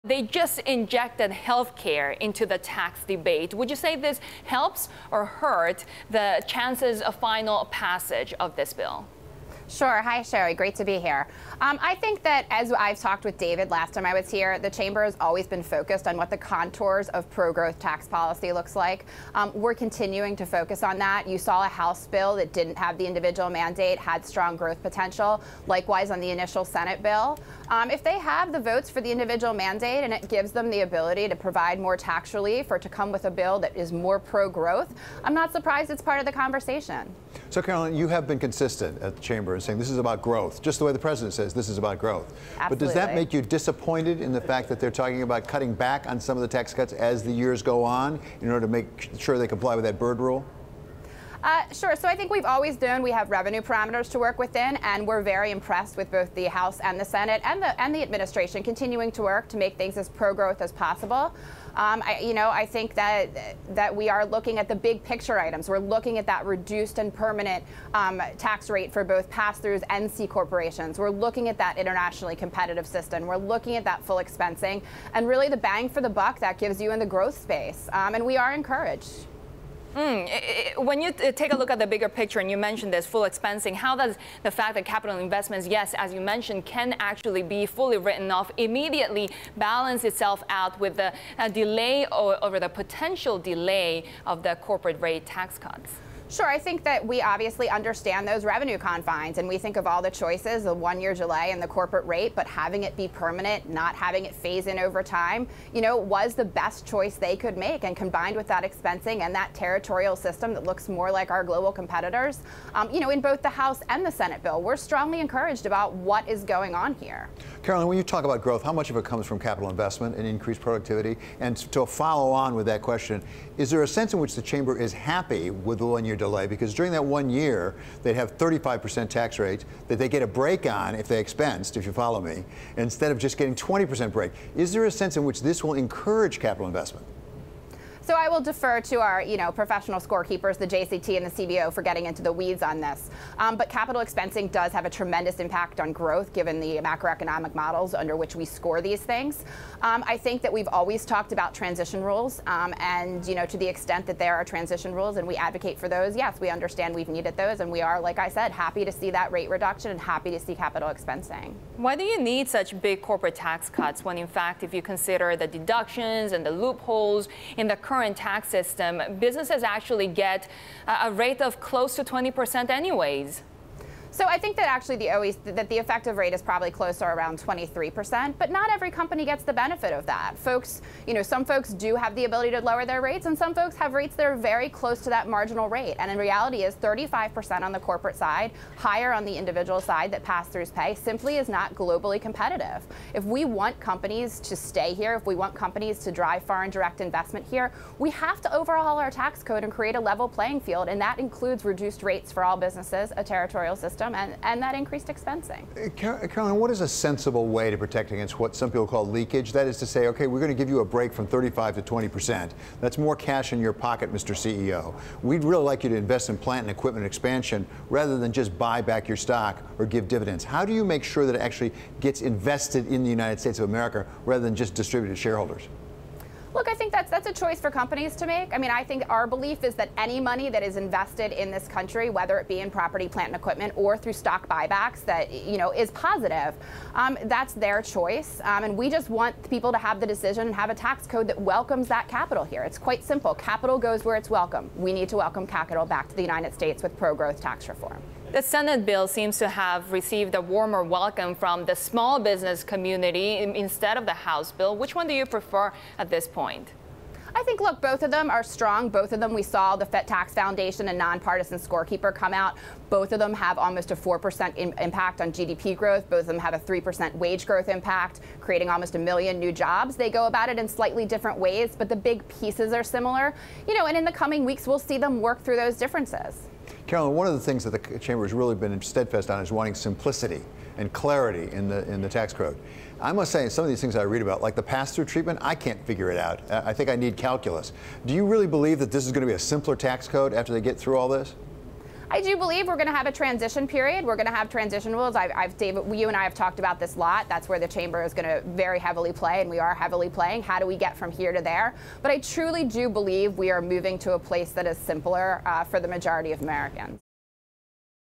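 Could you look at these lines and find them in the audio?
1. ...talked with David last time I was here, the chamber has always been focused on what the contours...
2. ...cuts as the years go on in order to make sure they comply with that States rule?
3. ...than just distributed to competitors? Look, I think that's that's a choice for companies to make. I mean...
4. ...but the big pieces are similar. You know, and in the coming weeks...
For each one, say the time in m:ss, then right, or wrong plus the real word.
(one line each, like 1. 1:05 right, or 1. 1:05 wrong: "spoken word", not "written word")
1. 0:12 right
2. 0:46 wrong: "Byrd", not "States"
3. 3:44 wrong: "shareholders", not "competitors"
4. 4:31 right.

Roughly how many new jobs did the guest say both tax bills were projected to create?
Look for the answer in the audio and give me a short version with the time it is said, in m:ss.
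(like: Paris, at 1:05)
almost a million, at 4:28.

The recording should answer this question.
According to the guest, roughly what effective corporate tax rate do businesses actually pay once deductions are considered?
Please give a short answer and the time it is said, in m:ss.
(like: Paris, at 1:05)
23%, at 2:57.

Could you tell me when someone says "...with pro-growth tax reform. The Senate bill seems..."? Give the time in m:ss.
4:06.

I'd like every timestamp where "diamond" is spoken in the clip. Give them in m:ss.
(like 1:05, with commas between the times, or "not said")
not said.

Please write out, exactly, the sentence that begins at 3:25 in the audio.
Uh, Caroline, what is a sensible way to protect against what some people call leakage?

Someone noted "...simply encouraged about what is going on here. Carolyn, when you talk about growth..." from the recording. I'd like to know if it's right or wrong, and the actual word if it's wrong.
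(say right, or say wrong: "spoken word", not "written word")
wrong: "strongly", not "simply".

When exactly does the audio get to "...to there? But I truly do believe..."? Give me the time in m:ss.
5:01.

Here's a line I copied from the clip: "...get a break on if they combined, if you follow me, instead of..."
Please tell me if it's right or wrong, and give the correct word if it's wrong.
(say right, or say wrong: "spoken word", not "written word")
wrong: "expensed", not "combined".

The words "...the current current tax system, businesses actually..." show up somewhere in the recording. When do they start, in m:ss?
2:47.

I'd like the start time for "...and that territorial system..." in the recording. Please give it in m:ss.
1:49.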